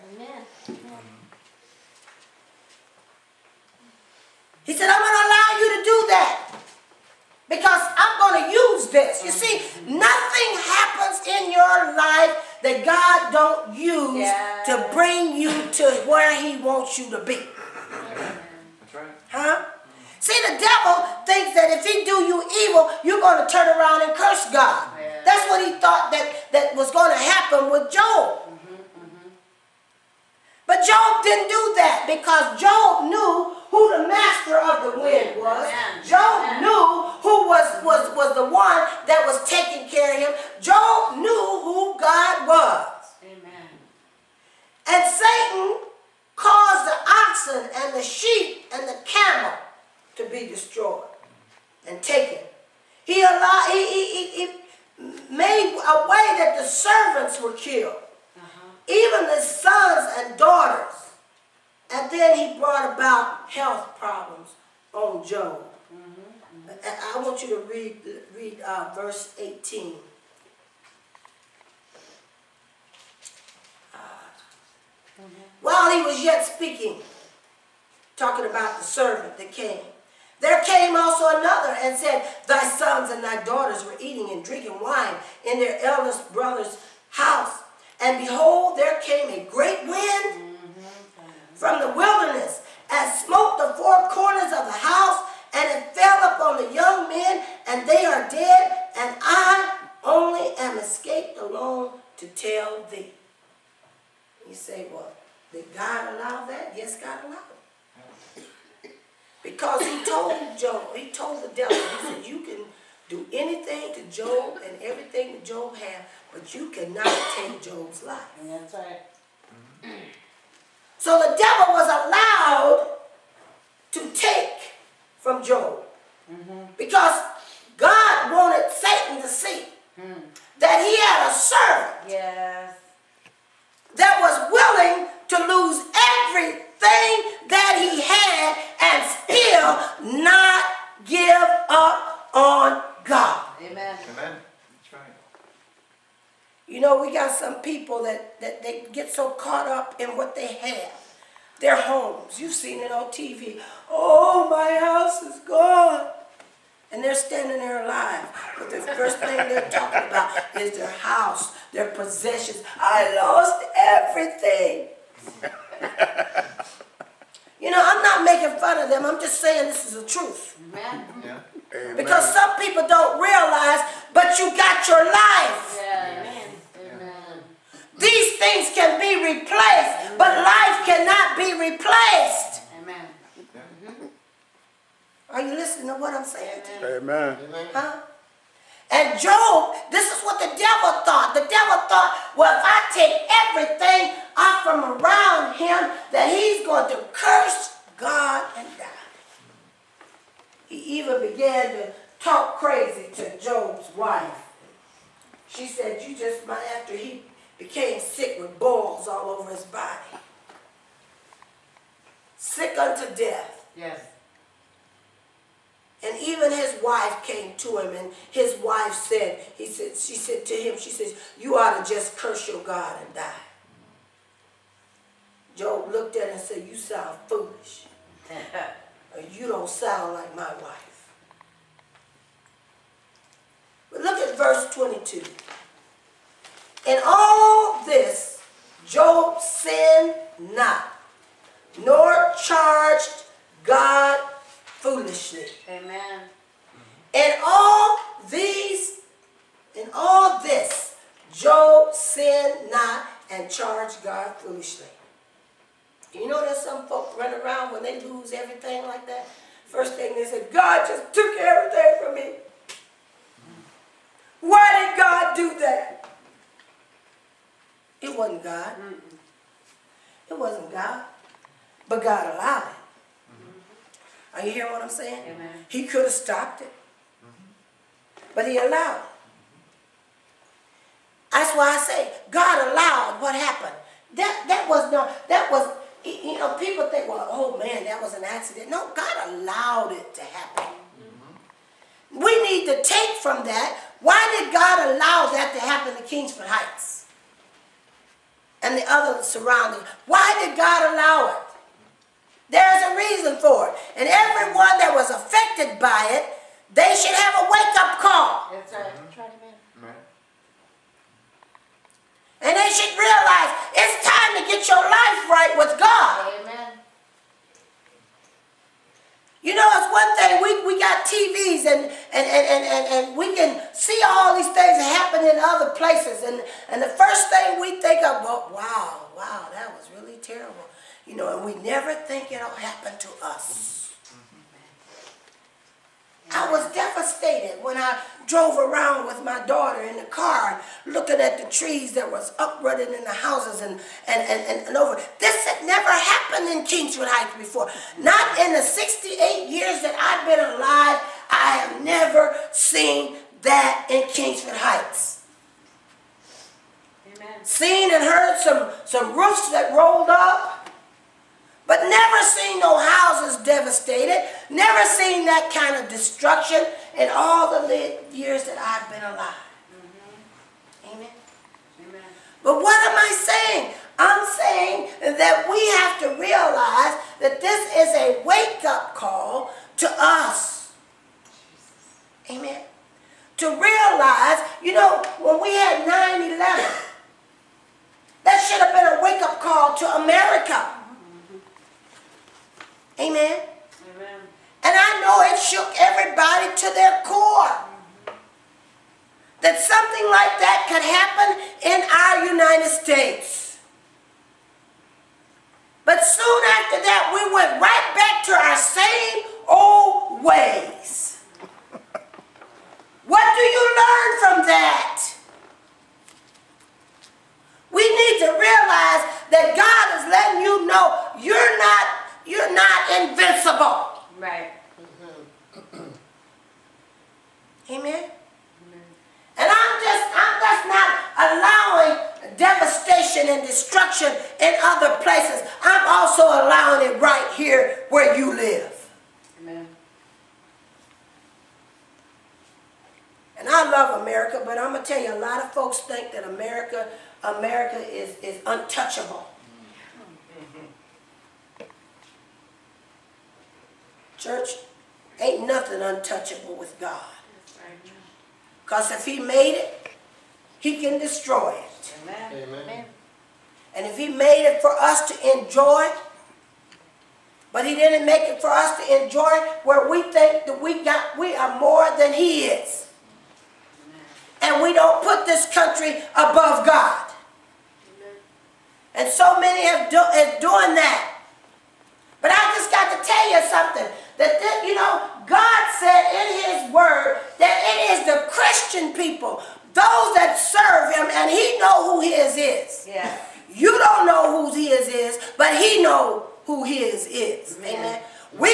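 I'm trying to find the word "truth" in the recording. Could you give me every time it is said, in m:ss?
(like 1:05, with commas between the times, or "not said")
2:50.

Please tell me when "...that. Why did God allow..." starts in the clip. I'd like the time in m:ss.
4:53.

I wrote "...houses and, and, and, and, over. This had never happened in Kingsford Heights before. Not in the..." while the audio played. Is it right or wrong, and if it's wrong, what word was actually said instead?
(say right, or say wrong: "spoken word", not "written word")
right.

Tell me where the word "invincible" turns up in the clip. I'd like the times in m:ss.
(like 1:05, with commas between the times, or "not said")
7:02.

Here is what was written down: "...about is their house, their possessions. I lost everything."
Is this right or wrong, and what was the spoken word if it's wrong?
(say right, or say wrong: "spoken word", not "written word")
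right.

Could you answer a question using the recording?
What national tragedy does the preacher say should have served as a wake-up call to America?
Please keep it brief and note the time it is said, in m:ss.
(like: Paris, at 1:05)
9/11, at 6:25.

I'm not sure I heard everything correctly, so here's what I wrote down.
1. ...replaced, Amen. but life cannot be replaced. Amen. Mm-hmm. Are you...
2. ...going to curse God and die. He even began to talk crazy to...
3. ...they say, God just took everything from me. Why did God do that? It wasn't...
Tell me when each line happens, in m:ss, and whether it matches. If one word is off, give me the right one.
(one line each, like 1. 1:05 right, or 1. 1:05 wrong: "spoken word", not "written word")
1. 2:59 right
2. 3:16 right
3. 4:20 right.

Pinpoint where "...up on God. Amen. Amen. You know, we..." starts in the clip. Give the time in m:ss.
2:21.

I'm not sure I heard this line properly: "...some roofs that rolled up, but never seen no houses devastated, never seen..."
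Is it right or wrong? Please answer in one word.
right.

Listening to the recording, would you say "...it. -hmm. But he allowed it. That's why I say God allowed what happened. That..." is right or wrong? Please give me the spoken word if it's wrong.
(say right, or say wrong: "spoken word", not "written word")
right.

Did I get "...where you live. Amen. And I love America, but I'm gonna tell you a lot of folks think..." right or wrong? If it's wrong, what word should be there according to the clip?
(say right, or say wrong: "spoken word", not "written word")
right.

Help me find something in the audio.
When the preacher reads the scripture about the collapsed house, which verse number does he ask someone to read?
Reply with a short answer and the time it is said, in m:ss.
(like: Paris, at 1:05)
18, at 1:08.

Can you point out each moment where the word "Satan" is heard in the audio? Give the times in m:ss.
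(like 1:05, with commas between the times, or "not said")
0:45, 2:08.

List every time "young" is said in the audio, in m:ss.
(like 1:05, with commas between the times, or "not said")
1:36.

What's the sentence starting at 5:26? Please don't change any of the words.
And, and the first thing we think of, well, wow, wow, that was really terrible.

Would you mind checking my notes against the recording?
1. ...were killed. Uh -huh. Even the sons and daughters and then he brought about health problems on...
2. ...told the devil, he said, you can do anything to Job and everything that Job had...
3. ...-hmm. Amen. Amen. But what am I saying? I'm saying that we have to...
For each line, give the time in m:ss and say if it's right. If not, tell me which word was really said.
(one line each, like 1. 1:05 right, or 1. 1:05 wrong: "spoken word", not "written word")
1. 0:57 right
2. 1:51 right
3. 6:09 right.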